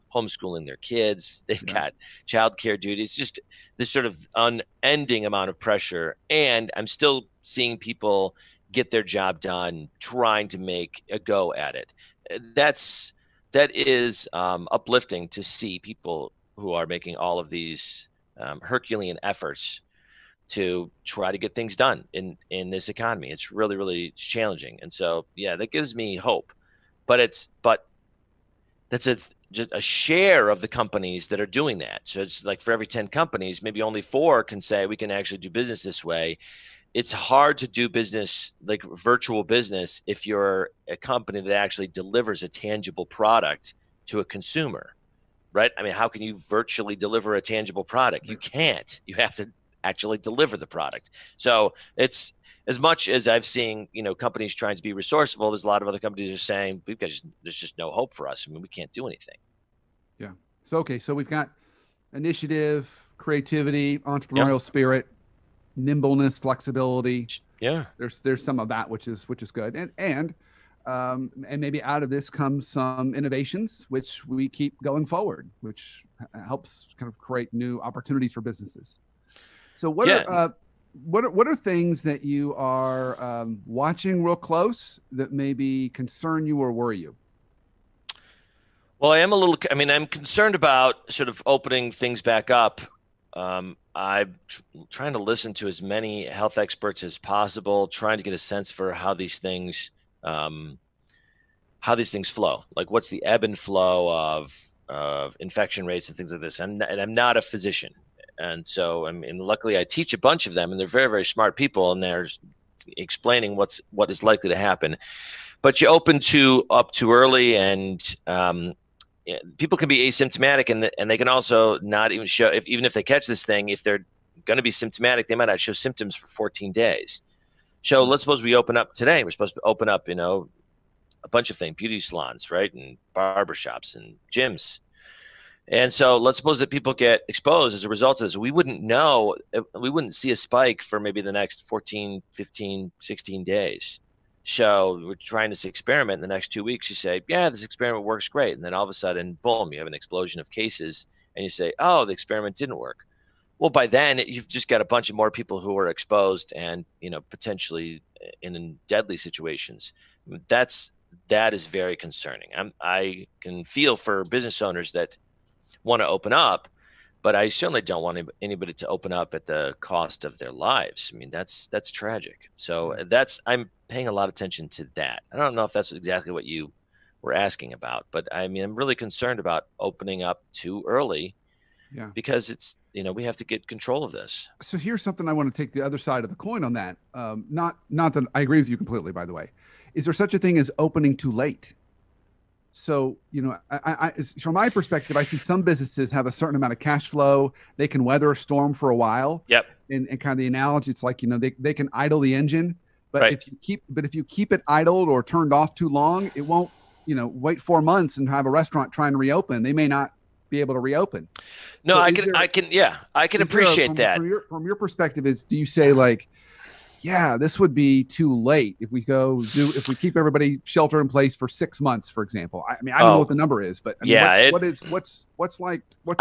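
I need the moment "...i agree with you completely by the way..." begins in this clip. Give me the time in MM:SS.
03:08.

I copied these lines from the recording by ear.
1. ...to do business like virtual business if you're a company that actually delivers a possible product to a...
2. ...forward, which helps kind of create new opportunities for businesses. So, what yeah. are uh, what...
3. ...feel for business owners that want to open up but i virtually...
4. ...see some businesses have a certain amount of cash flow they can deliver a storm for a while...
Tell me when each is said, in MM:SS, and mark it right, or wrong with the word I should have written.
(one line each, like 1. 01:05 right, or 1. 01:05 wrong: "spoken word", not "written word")
1. 00:37 wrong: "tangible", not "possible"
2. 01:15 right
3. 02:43 wrong: "certainly", not "virtually"
4. 03:15 wrong: "weather", not "deliver".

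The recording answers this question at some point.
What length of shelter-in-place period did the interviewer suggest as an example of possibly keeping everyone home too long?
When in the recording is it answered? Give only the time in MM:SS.
03:41.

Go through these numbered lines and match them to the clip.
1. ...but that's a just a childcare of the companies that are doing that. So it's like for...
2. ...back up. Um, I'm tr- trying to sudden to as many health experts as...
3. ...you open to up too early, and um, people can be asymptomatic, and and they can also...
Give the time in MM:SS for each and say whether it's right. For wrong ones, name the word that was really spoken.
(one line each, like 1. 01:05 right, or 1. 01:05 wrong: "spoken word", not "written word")
1. 00:27 wrong: "share", not "childcare"
2. 01:32 wrong: "listen", not "sudden"
3. 01:55 right.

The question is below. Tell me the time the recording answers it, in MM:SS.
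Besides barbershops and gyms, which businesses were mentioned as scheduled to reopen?
02:11.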